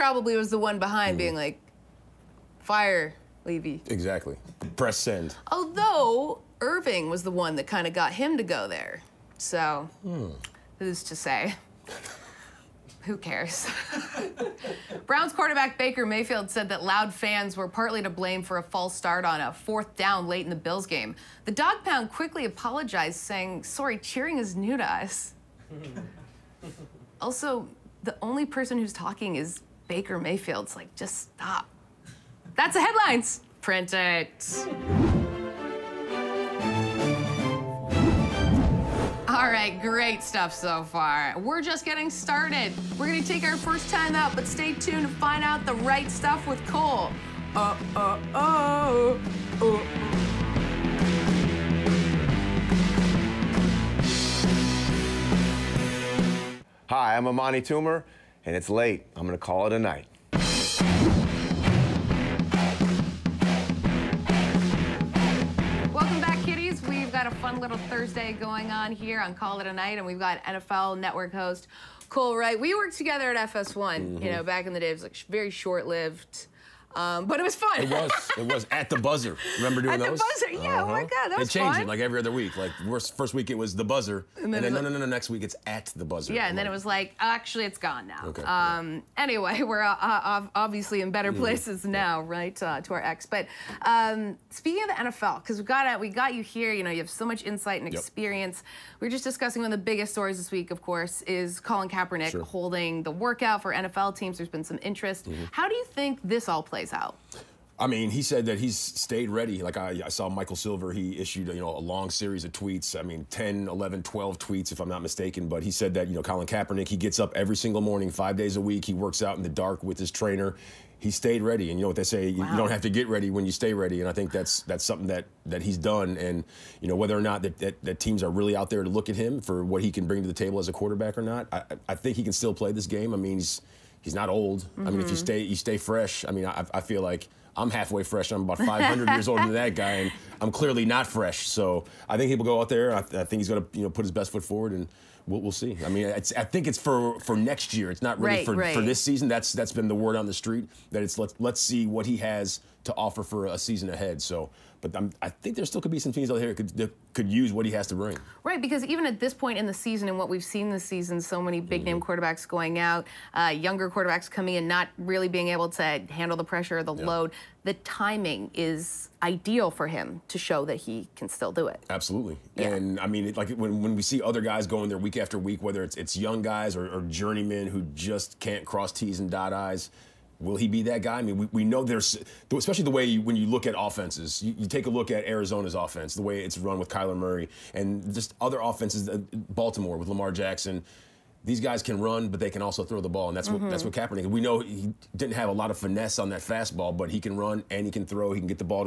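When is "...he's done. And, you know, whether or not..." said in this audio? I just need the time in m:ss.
2:05.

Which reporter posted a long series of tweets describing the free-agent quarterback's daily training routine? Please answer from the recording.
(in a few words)
Michael Silver.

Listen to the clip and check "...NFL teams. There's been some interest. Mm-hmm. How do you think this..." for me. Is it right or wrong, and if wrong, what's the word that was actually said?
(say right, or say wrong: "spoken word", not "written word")
right.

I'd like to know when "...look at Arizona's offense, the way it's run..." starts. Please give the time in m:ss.
3:04.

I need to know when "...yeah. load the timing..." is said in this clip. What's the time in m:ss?
2:46.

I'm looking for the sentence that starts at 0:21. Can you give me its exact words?
The dog pound quickly apologized, saying, Sorry, cheering is new to us.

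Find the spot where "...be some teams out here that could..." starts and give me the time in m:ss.
2:35.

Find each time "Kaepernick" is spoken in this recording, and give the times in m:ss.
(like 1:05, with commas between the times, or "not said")
1:41, 1:56, 3:13.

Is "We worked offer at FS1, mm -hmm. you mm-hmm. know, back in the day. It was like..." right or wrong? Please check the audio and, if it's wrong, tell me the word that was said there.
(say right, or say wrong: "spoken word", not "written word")
wrong: "together", not "offer".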